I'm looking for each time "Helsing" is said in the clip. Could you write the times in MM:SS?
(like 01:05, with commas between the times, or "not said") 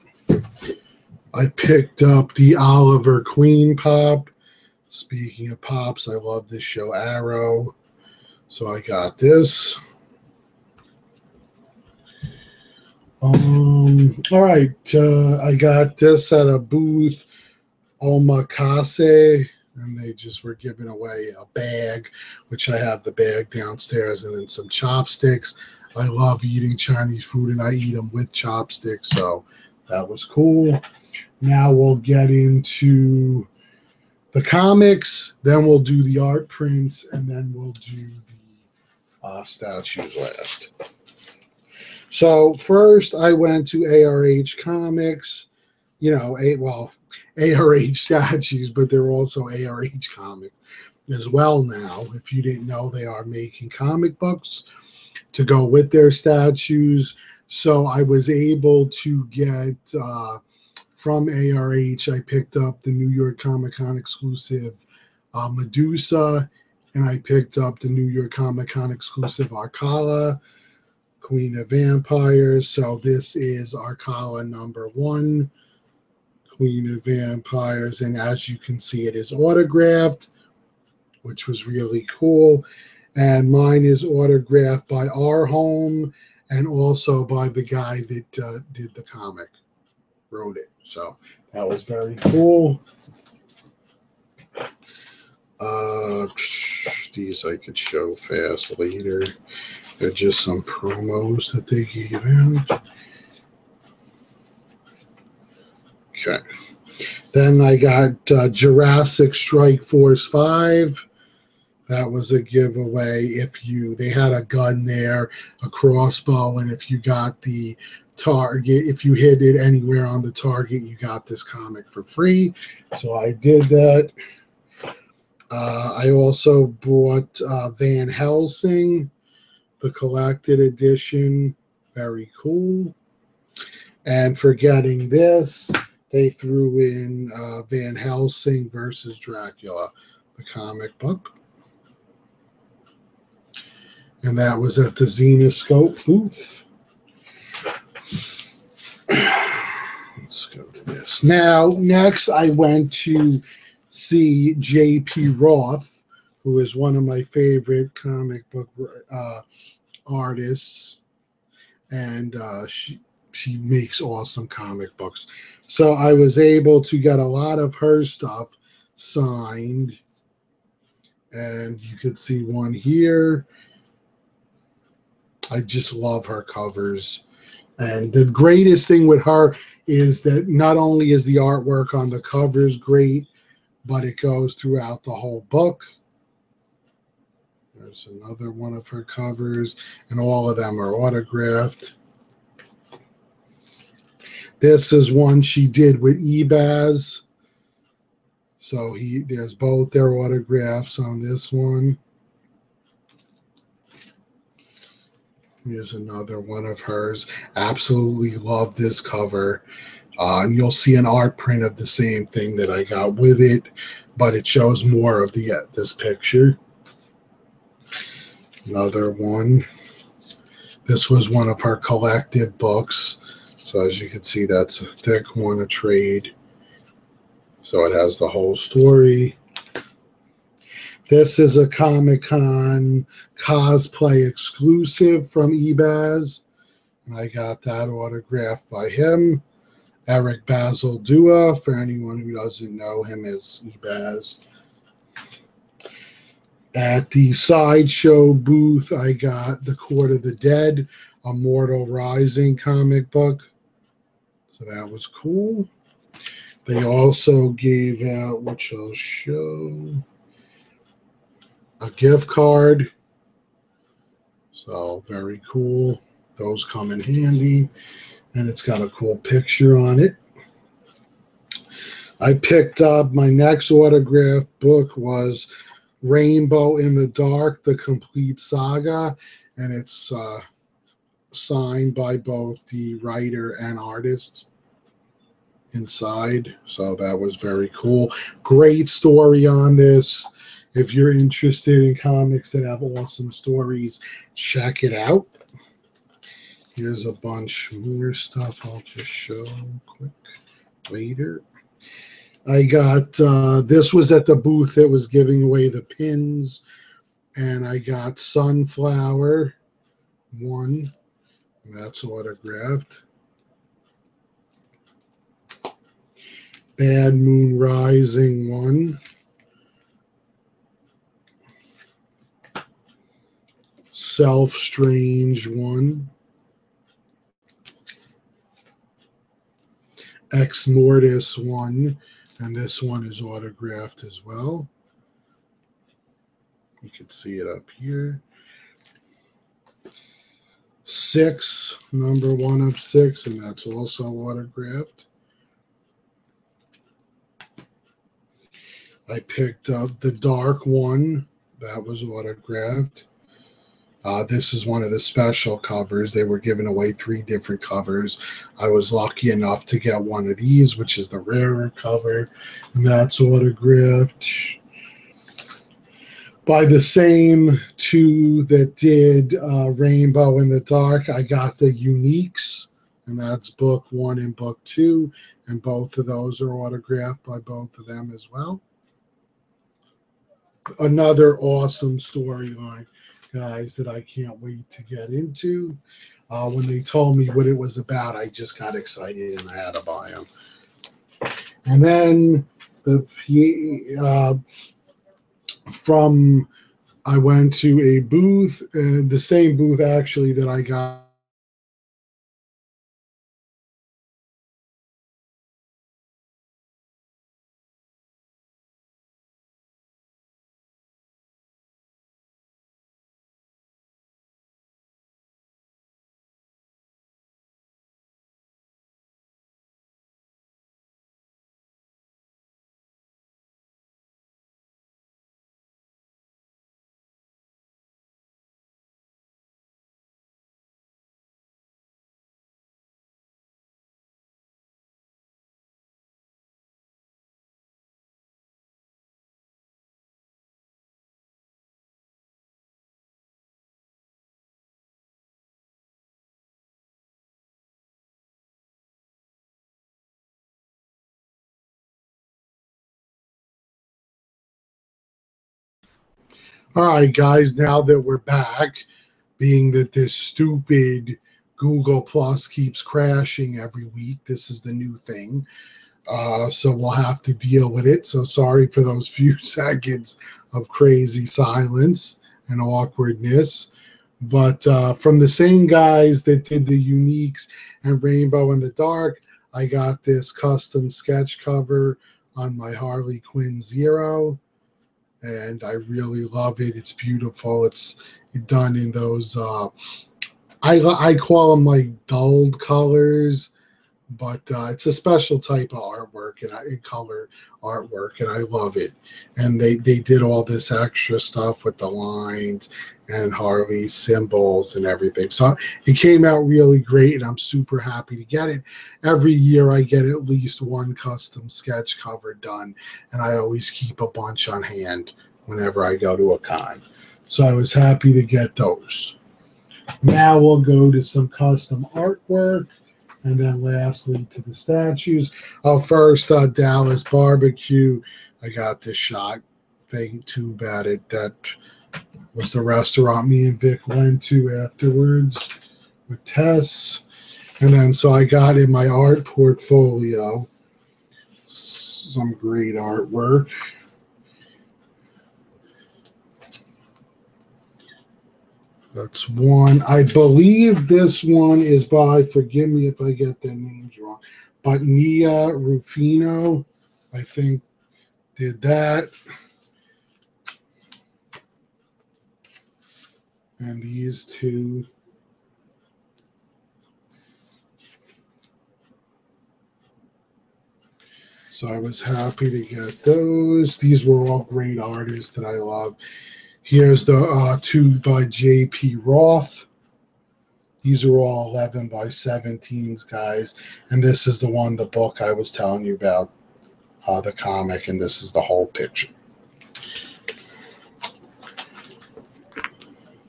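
02:08, 02:17.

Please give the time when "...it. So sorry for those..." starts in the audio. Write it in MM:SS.
07:47.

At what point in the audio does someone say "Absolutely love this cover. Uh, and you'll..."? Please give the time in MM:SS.
03:27.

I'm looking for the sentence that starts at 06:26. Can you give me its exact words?
Uh, when they told me what it was about, I just got excited and I had to buy them.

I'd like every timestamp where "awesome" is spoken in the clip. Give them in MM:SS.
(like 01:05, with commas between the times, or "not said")
02:44, 04:52, 06:21.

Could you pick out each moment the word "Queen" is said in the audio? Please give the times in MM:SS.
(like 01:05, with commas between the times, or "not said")
00:03, 01:11, 01:16.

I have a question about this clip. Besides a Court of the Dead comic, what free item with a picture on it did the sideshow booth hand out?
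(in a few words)
a gift card.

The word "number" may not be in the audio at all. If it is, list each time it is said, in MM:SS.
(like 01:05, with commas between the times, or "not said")
01:14, 05:41.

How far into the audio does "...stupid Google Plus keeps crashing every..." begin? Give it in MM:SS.
07:40.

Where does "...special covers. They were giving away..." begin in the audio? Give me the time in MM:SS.
05:54.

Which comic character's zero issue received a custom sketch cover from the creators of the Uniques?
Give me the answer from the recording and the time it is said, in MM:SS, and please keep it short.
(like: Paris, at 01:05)
Harley Quinn, at 08:02.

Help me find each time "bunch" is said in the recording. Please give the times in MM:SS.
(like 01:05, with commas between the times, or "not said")
04:57, 08:34.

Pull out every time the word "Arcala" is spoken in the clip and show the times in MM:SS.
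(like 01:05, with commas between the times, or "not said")
01:09, 01:13.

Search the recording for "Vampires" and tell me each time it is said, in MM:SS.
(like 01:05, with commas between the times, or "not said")
01:11, 01:17.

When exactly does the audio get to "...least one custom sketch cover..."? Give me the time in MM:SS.
08:30.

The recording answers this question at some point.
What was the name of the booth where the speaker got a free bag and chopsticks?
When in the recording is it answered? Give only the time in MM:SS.
00:18.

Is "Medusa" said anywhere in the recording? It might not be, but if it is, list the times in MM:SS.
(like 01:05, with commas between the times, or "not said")
01:05.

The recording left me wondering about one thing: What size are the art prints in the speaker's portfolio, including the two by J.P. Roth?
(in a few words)
11 by 17.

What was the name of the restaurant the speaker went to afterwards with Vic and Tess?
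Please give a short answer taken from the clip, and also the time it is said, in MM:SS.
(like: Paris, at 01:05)
Dallas Barbecue, at 08:46.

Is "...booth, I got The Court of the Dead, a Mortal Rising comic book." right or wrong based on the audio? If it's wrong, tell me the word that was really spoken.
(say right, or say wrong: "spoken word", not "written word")
right.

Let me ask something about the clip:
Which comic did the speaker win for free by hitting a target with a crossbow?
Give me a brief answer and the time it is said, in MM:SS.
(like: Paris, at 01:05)
Jurassic Strike Force 5, at 01:48.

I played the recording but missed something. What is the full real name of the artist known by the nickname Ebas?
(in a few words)
Eric Basaldua.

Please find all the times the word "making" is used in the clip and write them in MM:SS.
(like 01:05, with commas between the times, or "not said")
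00:53.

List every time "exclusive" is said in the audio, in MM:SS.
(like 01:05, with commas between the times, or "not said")
01:03, 01:08, 03:54.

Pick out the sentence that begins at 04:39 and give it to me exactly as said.
And it's uh, signed by both the writer and artist inside.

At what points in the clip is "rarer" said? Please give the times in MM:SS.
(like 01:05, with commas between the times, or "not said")
06:01.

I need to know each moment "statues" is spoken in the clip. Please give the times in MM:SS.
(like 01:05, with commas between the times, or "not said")
00:39, 00:47, 00:56, 08:44.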